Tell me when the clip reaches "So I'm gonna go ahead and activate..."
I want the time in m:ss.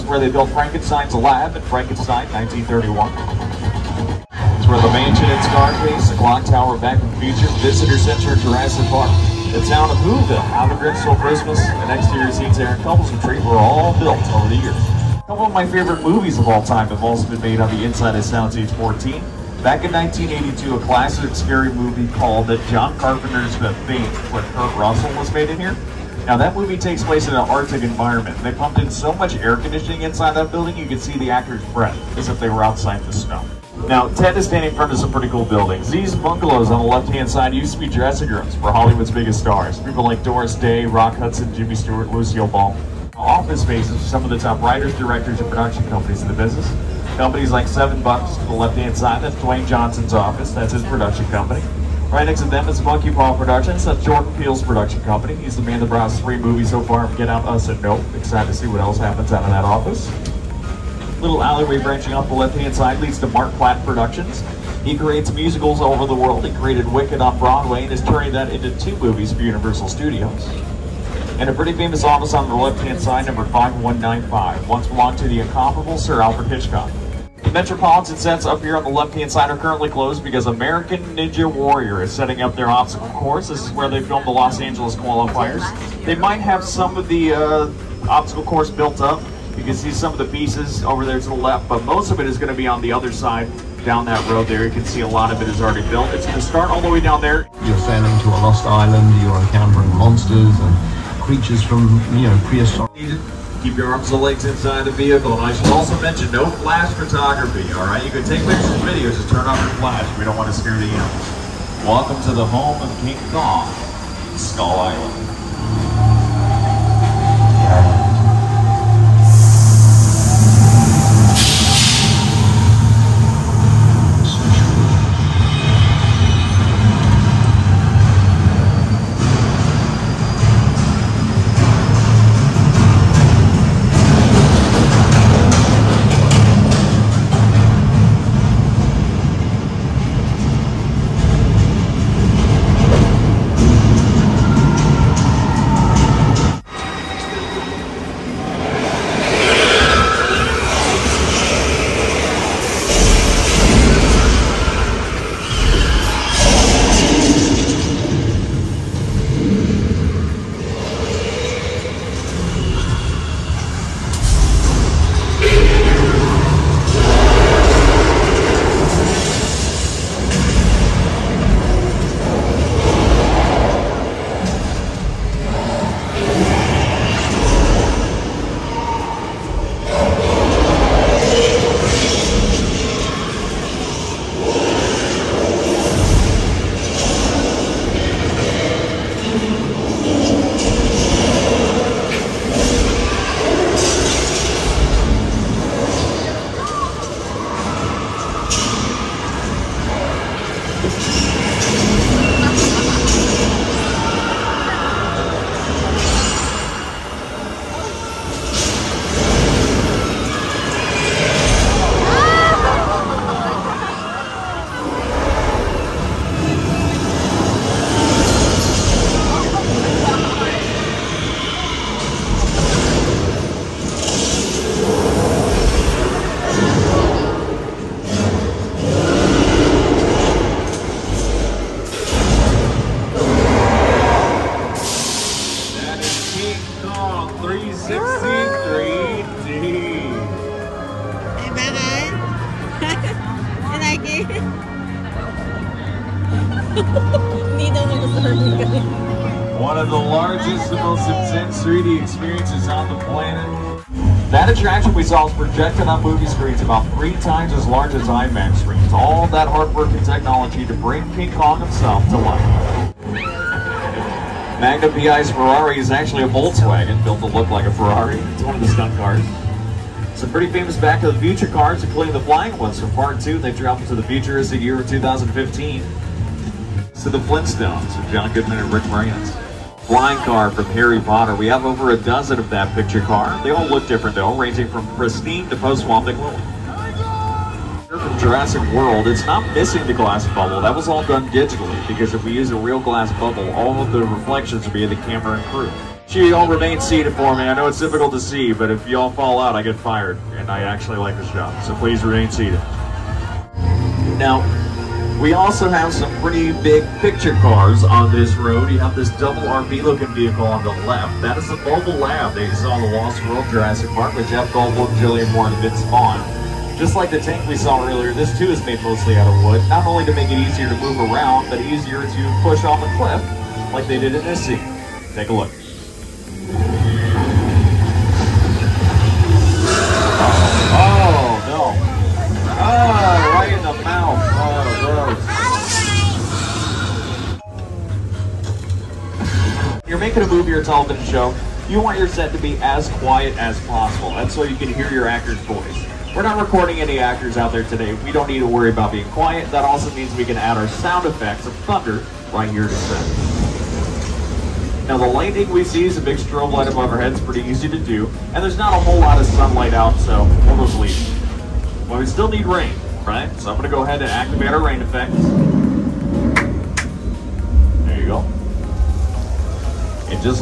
6:03.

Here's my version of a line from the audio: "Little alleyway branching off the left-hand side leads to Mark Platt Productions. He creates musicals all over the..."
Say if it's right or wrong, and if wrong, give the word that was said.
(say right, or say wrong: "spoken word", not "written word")
right.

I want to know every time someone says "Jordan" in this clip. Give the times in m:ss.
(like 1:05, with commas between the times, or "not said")
0:54.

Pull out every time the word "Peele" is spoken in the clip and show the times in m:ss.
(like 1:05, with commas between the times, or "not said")
0:54.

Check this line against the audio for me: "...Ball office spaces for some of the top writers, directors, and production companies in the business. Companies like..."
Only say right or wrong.
right.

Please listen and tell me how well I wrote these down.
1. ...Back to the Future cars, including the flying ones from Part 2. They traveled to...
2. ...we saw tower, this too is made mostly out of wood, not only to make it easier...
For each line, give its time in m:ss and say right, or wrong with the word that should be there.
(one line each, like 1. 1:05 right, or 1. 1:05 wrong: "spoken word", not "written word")
1. 4:30 right
2. 5:17 wrong: "earlier", not "tower".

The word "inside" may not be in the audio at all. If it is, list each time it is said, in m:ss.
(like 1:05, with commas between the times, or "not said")
0:17, 0:30, 1:44.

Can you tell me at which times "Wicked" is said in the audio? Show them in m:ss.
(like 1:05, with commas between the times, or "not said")
1:06.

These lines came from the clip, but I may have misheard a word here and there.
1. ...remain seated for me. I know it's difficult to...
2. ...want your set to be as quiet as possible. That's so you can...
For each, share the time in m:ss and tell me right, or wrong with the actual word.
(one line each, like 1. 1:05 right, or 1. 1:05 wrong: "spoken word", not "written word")
1. 4:56 right
2. 5:41 right.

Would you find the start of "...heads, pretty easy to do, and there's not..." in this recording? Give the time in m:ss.
5:57.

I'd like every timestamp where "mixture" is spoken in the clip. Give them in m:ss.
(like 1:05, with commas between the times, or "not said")
not said.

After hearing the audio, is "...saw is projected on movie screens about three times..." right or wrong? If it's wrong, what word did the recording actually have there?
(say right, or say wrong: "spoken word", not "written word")
right.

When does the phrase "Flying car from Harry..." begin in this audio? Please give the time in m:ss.
4:39.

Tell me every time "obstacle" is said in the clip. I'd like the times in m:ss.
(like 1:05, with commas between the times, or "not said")
1:22, 1:28.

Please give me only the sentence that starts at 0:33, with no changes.
Now, Ted is standing in front of some pretty cool buildings.